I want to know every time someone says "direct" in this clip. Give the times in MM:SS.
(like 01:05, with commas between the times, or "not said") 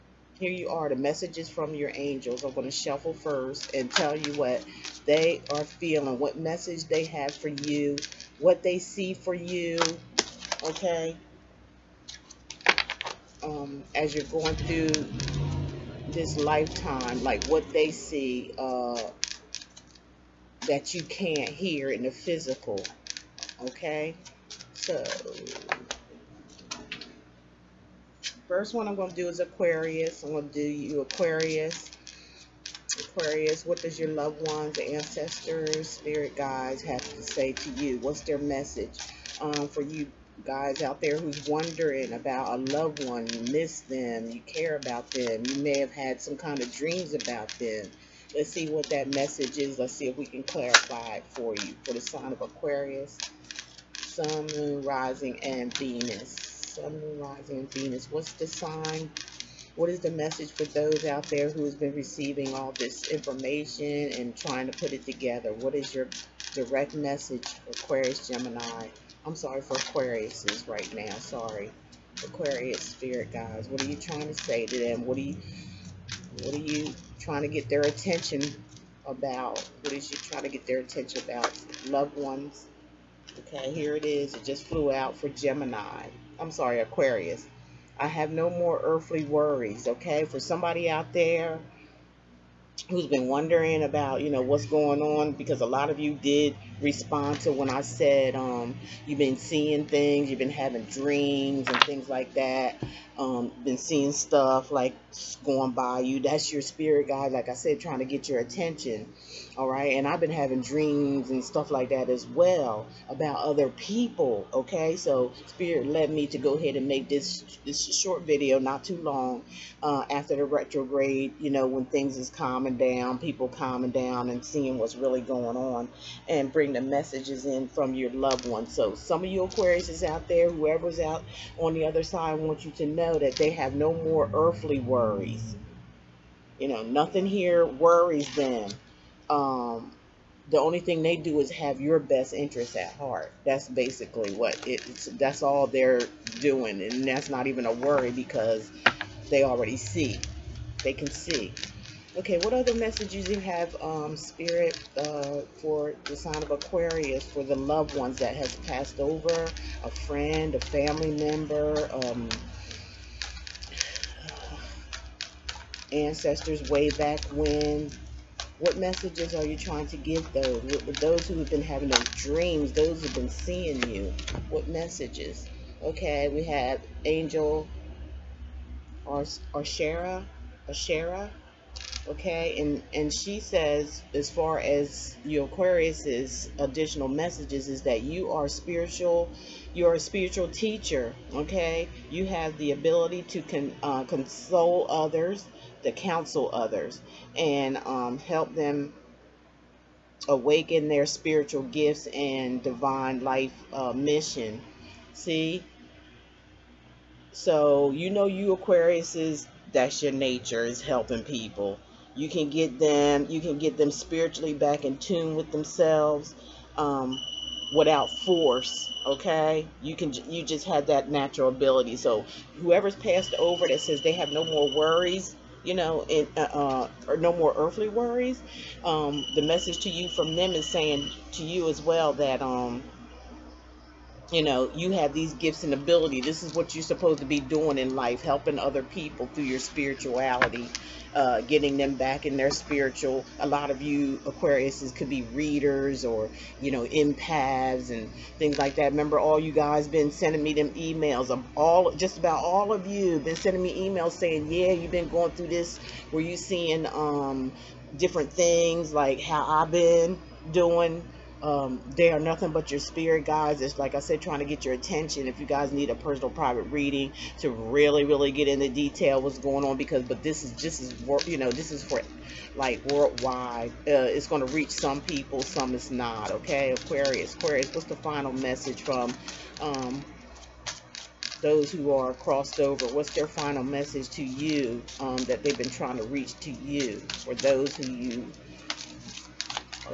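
01:06.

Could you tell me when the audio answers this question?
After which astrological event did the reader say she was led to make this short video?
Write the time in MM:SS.
02:00.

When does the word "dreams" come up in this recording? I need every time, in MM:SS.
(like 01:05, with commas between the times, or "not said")
00:46, 01:40, 01:50, 02:52.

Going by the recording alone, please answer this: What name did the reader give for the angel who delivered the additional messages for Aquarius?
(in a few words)
Shara.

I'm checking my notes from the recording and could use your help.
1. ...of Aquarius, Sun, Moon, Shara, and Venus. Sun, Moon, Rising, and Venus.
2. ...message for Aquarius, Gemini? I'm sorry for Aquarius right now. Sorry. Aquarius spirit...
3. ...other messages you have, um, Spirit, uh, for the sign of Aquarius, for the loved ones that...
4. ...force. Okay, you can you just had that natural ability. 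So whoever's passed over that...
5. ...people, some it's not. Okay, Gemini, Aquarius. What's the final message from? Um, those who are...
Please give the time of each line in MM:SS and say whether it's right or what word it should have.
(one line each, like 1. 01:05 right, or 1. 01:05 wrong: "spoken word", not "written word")
1. 00:52 wrong: "Rising", not "Shara"
2. 01:06 right
3. 02:32 right
4. 03:38 right
5. 04:35 wrong: "Aquarius", not "Gemini".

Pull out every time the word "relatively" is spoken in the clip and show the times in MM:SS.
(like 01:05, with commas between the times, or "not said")
not said.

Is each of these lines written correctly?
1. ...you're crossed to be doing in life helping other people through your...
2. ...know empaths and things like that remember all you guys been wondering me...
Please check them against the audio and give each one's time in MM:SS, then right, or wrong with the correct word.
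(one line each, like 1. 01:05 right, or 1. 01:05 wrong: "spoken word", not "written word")
1. 03:56 wrong: "supposed", not "crossed"
2. 04:06 wrong: "sending", not "wondering".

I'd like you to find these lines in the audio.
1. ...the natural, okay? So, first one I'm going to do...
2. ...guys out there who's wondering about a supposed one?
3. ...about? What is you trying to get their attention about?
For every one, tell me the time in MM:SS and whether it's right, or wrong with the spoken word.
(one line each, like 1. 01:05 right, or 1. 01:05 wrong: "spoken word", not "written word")
1. 00:22 wrong: "physical", not "natural"
2. 00:40 wrong: "loved", not "supposed"
3. 01:19 right.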